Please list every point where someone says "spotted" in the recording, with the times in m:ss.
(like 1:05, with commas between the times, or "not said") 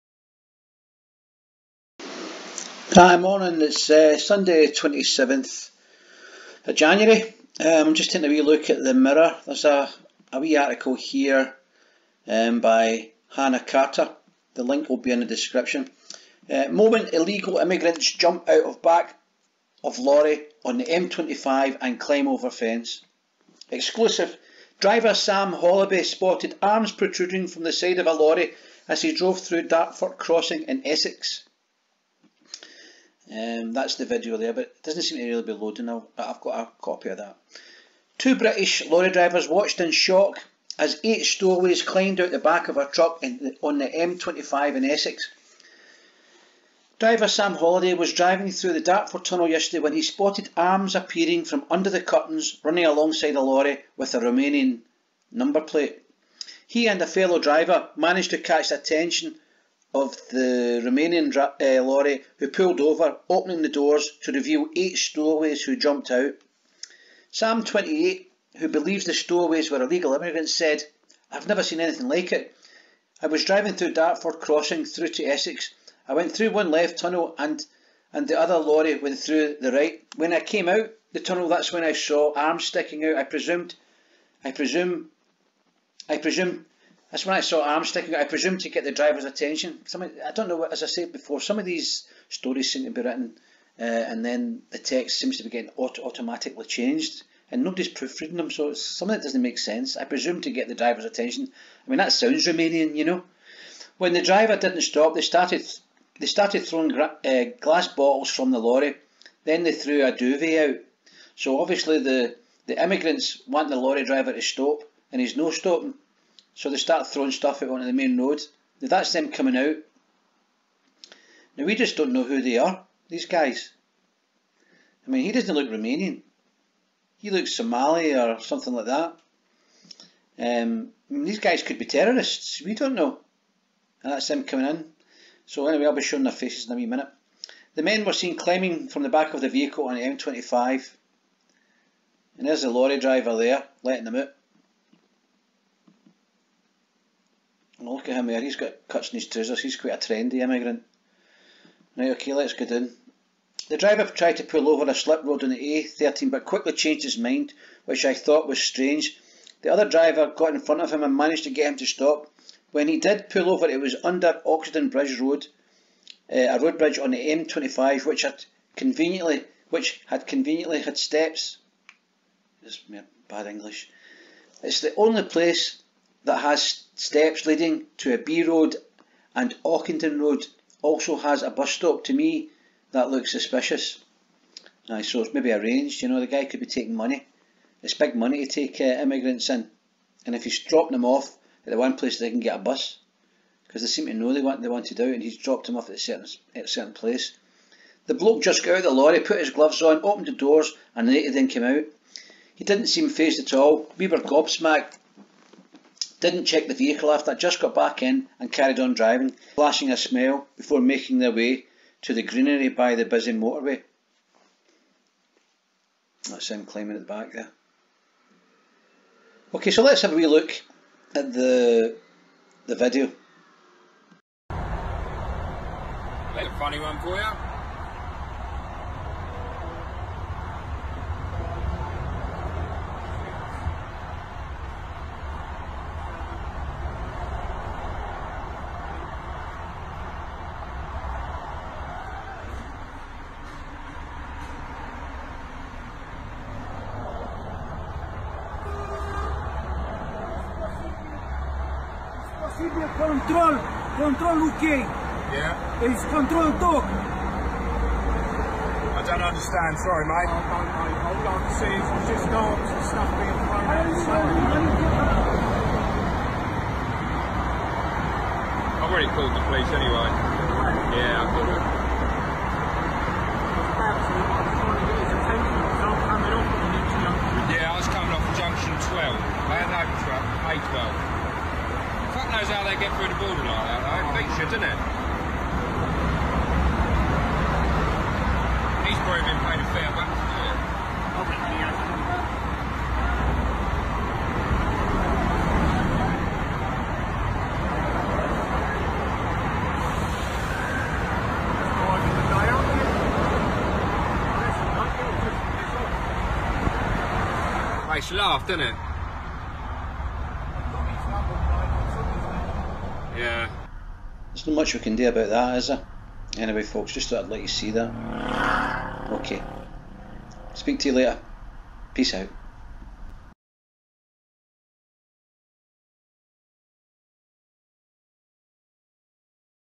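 0:26, 0:50.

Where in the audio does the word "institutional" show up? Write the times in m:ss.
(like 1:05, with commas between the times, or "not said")
not said.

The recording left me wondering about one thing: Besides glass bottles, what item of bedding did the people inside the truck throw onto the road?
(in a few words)
A duvet.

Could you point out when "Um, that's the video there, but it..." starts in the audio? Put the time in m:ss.
0:33.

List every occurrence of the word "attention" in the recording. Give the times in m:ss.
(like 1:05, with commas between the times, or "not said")
0:58, 1:29, 1:41.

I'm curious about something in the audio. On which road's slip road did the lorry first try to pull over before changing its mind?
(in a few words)
A13.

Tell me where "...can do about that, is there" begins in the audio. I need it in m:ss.
5:14.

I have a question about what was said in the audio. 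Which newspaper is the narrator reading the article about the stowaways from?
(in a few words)
The Mirror.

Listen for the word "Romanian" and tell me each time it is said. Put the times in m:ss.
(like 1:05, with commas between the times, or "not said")
0:54, 1:00, 1:42, 2:05.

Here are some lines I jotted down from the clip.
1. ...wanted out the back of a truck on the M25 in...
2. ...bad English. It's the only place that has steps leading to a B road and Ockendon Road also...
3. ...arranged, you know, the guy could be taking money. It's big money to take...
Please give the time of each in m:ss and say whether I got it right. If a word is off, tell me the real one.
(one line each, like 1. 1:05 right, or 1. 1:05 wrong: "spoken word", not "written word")
1. 0:41 wrong: "climbed", not "wanted"
2. 2:53 right
3. 3:05 right.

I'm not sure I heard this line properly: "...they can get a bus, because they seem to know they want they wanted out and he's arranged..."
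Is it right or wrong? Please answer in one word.
wrong.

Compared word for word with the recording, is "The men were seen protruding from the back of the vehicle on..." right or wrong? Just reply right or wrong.
wrong.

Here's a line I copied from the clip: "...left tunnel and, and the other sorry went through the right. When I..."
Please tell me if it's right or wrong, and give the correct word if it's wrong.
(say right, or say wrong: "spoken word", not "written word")
wrong: "lorry", not "sorry".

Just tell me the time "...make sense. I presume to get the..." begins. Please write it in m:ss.
1:39.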